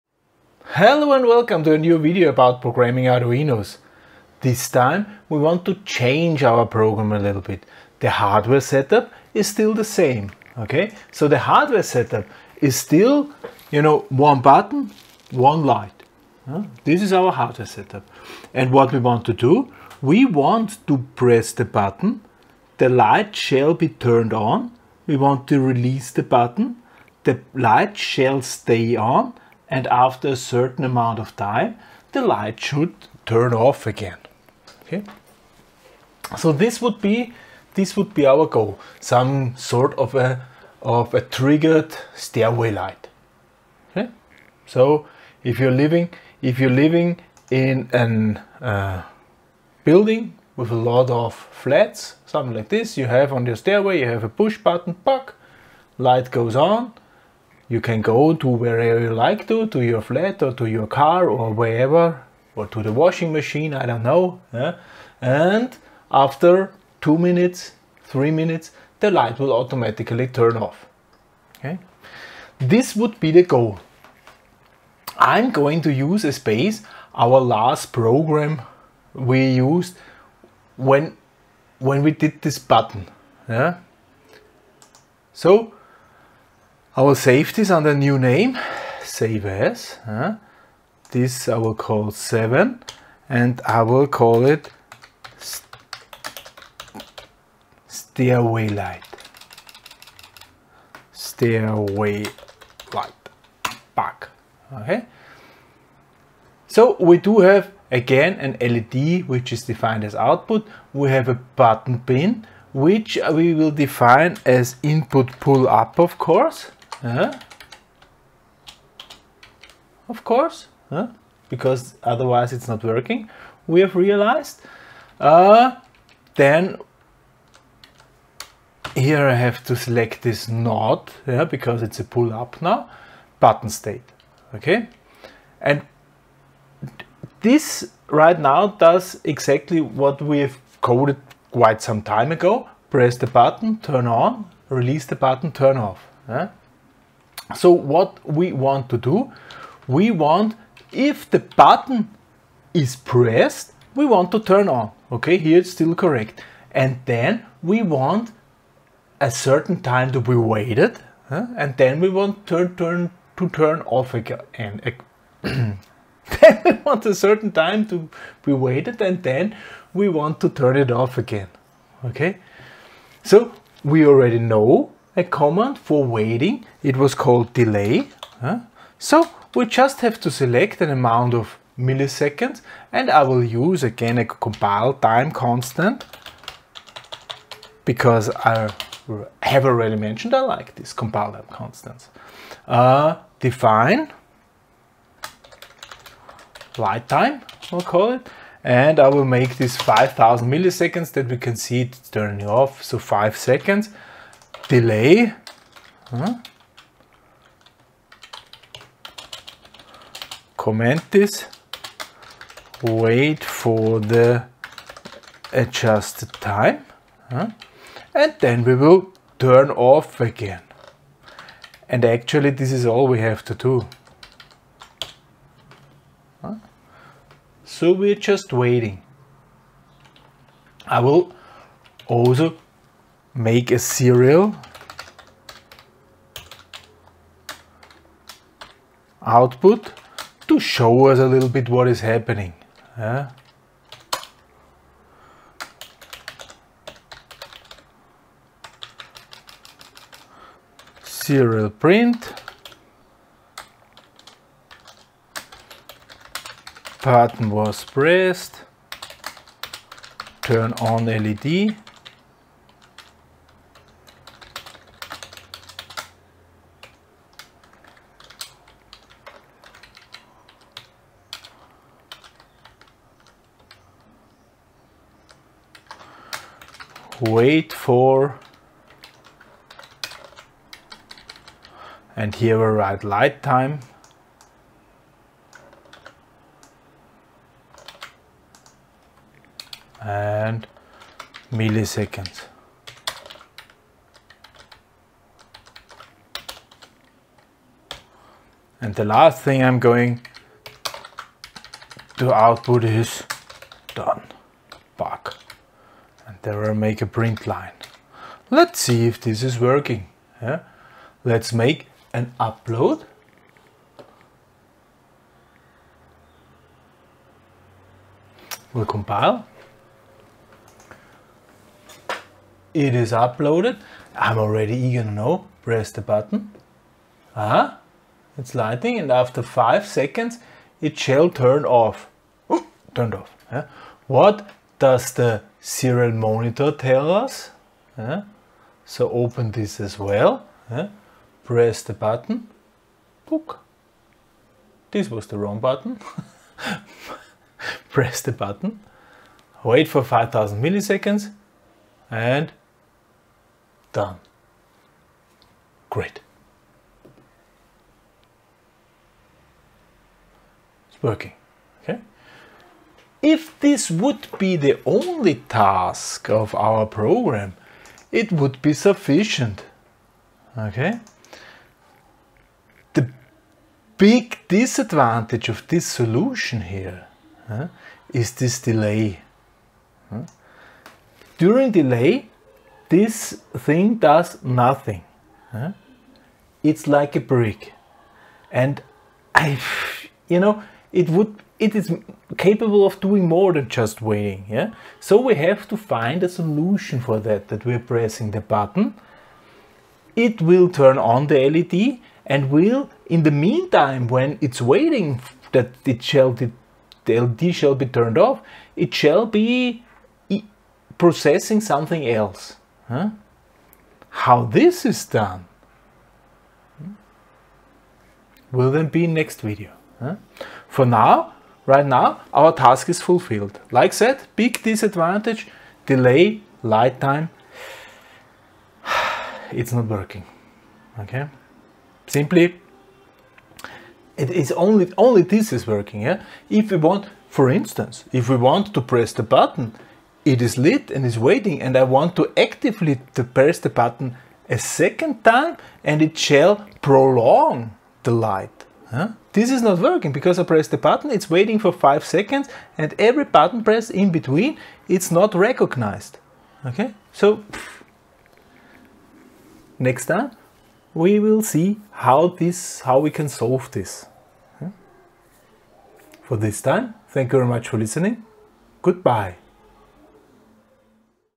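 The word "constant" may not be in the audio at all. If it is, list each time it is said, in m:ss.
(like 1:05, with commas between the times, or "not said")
3:05, 3:11.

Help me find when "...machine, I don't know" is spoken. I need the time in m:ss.
1:03.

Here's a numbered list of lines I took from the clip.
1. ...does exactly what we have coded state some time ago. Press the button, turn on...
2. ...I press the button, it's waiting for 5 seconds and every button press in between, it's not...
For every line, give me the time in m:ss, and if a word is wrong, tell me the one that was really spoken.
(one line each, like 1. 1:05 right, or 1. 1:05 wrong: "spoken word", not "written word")
1. 2:18 wrong: "quite", not "state"
2. 7:30 right.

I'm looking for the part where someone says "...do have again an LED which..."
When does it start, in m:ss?
1:47.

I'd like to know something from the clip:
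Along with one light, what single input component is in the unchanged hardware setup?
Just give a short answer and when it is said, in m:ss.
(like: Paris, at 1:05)
one button, at 0:14.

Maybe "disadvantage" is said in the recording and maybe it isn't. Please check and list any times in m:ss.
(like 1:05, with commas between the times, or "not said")
6:14, 7:04.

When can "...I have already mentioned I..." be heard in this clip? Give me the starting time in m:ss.
3:08.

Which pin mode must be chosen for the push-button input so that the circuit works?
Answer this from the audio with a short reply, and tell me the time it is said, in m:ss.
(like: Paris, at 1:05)
input pull up, at 1:54.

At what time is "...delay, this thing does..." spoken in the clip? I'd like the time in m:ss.
6:21.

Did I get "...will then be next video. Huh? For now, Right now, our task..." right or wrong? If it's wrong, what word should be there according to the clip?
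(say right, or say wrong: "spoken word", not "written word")
right.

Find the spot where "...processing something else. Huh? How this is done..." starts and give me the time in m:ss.
6:50.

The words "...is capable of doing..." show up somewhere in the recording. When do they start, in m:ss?
6:31.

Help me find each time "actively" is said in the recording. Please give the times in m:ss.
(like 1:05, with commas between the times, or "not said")
7:22.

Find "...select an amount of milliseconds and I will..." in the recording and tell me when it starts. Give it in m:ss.
3:00.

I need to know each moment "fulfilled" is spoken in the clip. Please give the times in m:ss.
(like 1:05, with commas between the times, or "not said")
7:03.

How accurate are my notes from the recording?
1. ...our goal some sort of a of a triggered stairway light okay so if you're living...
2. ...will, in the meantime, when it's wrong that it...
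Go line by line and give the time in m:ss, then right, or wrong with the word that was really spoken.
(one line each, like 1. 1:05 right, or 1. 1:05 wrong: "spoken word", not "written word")
1. 0:38 right
2. 6:42 wrong: "waiting", not "wrong".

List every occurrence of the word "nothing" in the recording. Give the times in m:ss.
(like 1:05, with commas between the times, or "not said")
6:24.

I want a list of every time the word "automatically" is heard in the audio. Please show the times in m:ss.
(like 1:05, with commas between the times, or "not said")
1:09.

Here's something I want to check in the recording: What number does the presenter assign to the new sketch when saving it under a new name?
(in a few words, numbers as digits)
7.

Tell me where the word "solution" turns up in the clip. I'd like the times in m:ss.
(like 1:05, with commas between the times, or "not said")
6:15, 6:36.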